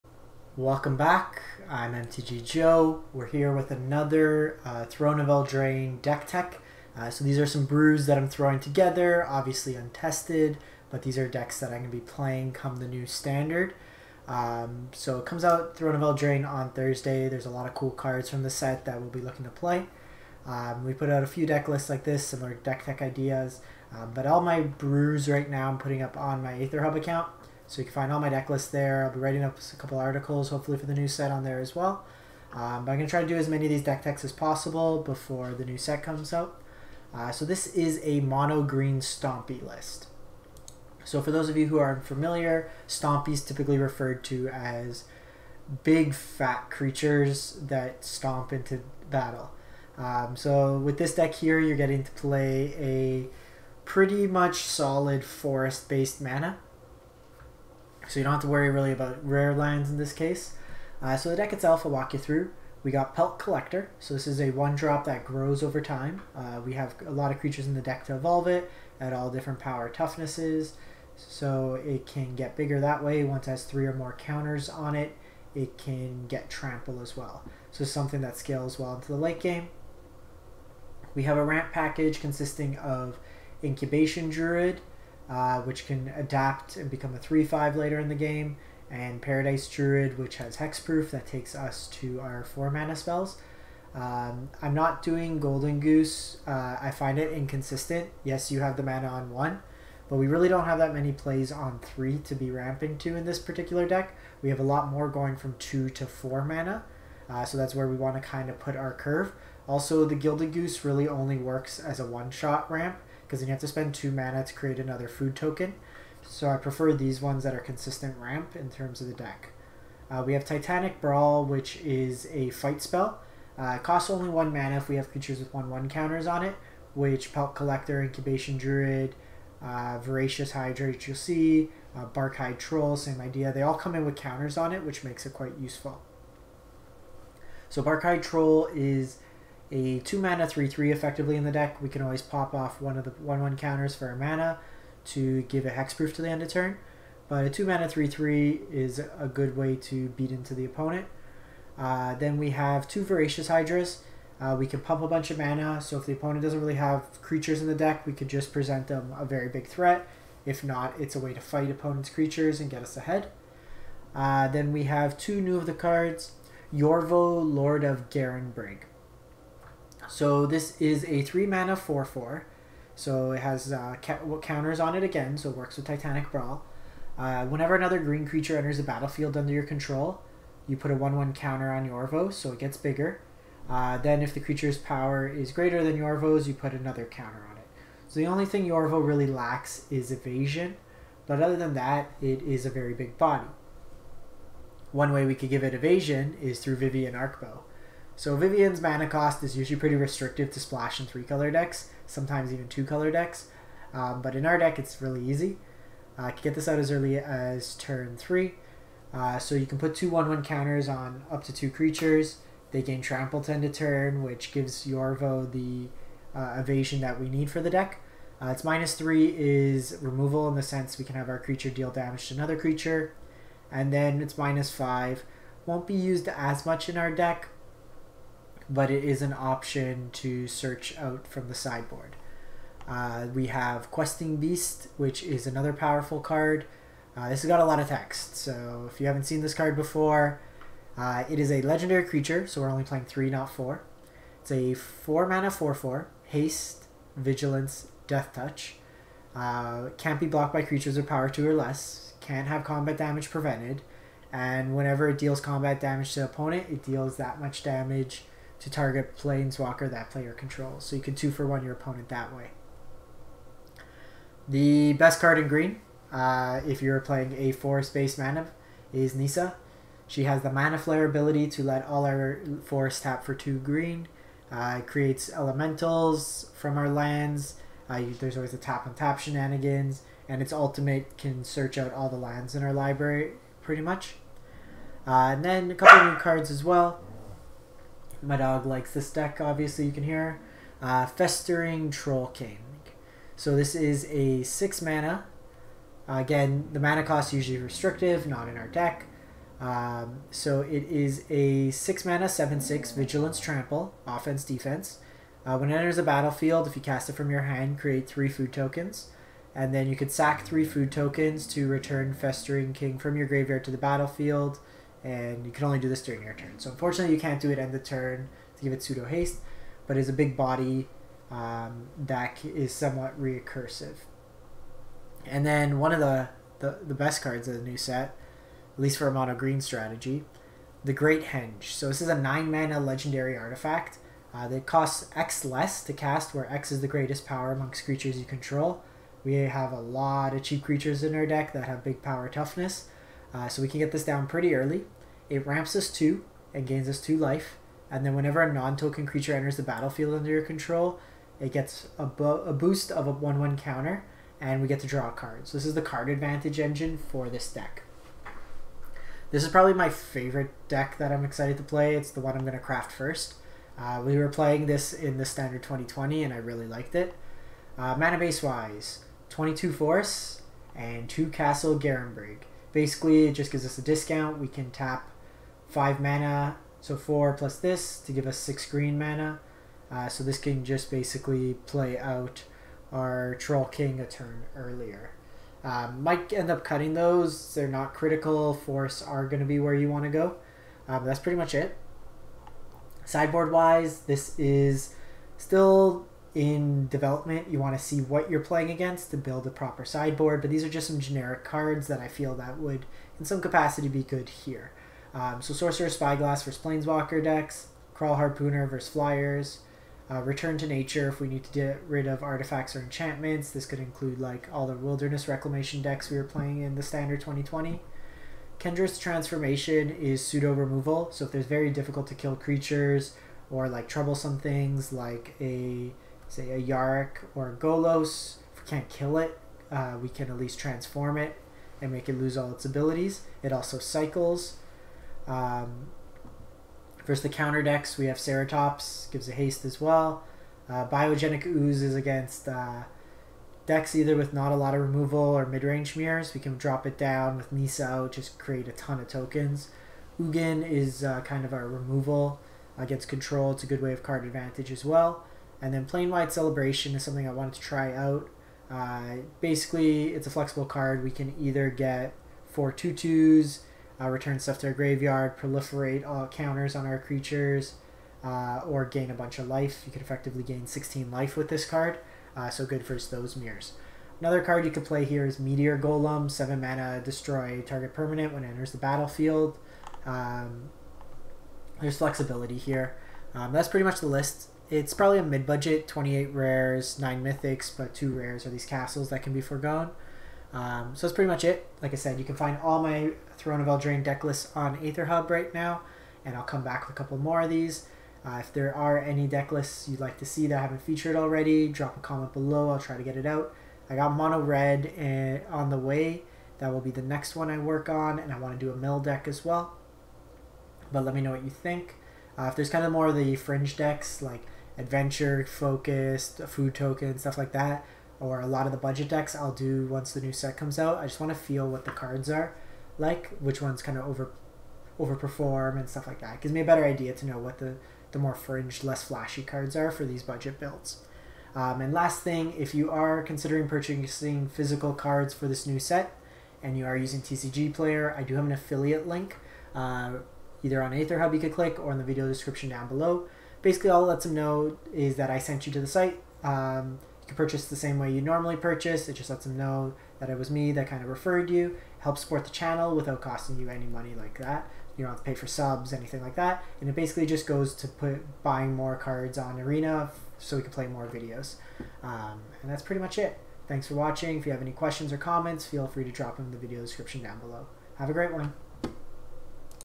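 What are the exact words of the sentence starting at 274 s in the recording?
Uh, it creates elementals from our lands.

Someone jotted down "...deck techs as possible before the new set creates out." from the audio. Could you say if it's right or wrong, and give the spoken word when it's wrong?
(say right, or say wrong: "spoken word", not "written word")
wrong: "comes", not "creates".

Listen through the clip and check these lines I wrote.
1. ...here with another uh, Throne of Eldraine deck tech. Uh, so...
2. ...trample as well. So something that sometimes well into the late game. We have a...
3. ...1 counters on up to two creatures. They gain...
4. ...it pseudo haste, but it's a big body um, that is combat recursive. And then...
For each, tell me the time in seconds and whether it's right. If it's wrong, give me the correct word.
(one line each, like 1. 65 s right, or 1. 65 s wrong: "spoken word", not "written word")
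1. 3 s right
2. 76 s wrong: "scales", not "sometimes"
3. 210 s right
4. 318 s wrong: "somewhat", not "combat".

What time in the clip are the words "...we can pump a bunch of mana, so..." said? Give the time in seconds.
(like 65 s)
154 s.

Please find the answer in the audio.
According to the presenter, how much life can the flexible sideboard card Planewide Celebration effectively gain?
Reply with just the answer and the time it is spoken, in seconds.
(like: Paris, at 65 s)
16, at 470 s.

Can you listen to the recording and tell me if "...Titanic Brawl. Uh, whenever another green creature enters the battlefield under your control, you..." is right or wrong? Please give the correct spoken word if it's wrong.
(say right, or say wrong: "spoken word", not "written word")
right.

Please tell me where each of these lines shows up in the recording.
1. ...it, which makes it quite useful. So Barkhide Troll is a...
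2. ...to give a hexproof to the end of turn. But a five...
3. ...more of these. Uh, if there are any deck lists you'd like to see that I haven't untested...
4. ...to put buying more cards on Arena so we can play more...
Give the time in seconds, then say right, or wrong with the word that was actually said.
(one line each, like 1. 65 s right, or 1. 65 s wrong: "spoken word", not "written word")
1. 134 s right
2. 145 s wrong: "two", not "five"
3. 497 s wrong: "featured", not "untested"
4. 557 s right.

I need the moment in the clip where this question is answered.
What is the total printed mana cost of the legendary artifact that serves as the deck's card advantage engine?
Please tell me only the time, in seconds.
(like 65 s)
332 s.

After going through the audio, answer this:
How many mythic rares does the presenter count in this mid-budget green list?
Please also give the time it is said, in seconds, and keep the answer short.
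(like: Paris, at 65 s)
9, at 486 s.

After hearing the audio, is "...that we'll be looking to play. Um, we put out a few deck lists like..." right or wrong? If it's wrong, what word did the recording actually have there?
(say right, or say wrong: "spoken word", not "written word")
right.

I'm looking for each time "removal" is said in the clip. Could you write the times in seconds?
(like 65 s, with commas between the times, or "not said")
220 s, 420 s, 444 s, 451 s.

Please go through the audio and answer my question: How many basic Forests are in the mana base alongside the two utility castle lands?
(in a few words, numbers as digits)
22.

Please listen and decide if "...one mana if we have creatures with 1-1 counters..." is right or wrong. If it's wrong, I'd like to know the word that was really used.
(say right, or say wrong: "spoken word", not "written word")
right.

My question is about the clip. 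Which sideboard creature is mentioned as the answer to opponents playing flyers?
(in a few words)
Kraul Harpooner.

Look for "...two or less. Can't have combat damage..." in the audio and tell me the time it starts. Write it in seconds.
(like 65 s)
251 s.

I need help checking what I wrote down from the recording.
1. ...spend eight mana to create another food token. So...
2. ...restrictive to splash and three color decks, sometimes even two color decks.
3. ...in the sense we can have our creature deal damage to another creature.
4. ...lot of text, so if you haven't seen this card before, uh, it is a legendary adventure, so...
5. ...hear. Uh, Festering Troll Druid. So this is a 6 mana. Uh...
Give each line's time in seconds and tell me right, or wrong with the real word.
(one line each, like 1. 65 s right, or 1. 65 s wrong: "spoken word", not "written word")
1. 113 s wrong: "two", not "eight"
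2. 199 s right
3. 220 s right
4. 237 s wrong: "creature", not "adventure"
5. 290 s wrong: "King", not "Druid".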